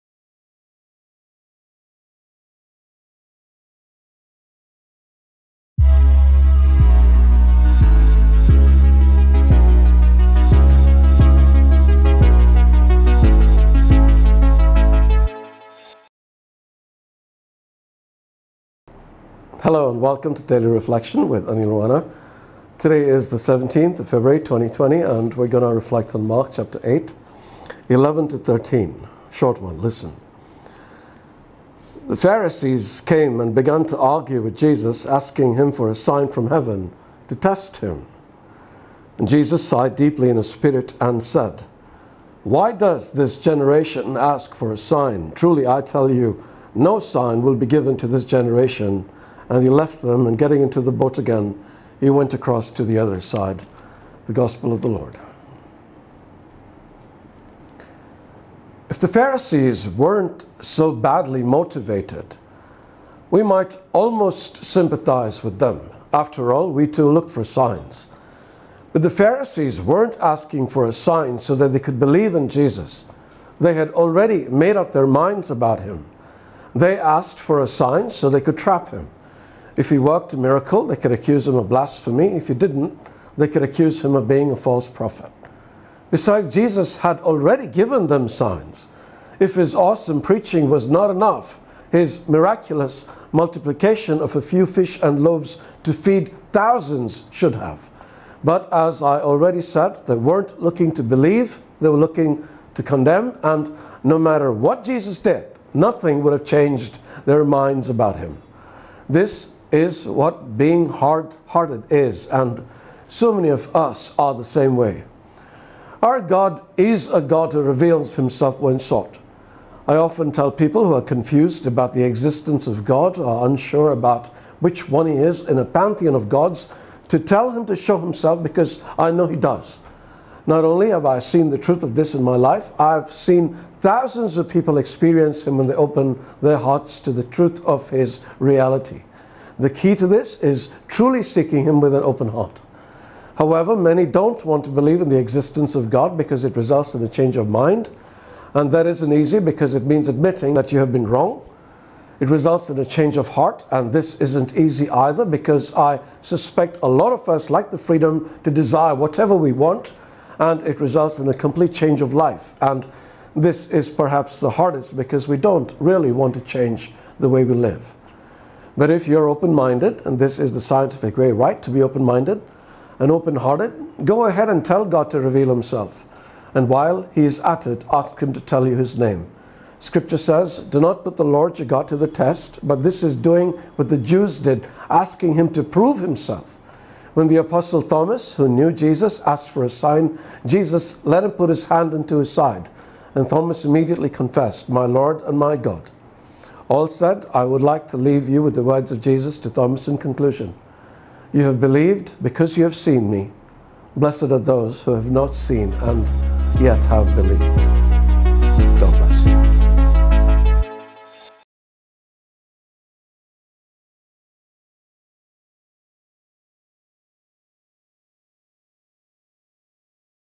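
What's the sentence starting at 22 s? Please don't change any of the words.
Today is the 17th of February 2020 and we're going to reflect on Mark chapter 8, 11 to 13.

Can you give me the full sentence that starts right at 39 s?
And Jesus sighed deeply in his spirit and said, Why does this generation ask for a sign?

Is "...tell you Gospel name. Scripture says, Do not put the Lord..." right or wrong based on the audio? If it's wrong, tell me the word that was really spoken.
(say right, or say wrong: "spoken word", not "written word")
wrong: "His", not "Gospel".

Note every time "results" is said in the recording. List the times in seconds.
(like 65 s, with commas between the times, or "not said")
146 s, 152 s, 160 s.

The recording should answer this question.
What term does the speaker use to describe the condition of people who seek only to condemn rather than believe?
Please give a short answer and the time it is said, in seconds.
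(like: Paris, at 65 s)
Hard hearted, at 110 s.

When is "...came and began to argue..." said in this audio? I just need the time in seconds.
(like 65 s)
33 s.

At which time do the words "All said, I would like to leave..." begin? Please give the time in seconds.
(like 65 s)
196 s.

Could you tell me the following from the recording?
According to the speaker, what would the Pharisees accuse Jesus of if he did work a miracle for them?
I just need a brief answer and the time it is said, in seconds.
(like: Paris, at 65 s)
Blasphemy, at 81 s.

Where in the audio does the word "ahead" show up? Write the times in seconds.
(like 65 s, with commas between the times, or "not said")
174 s.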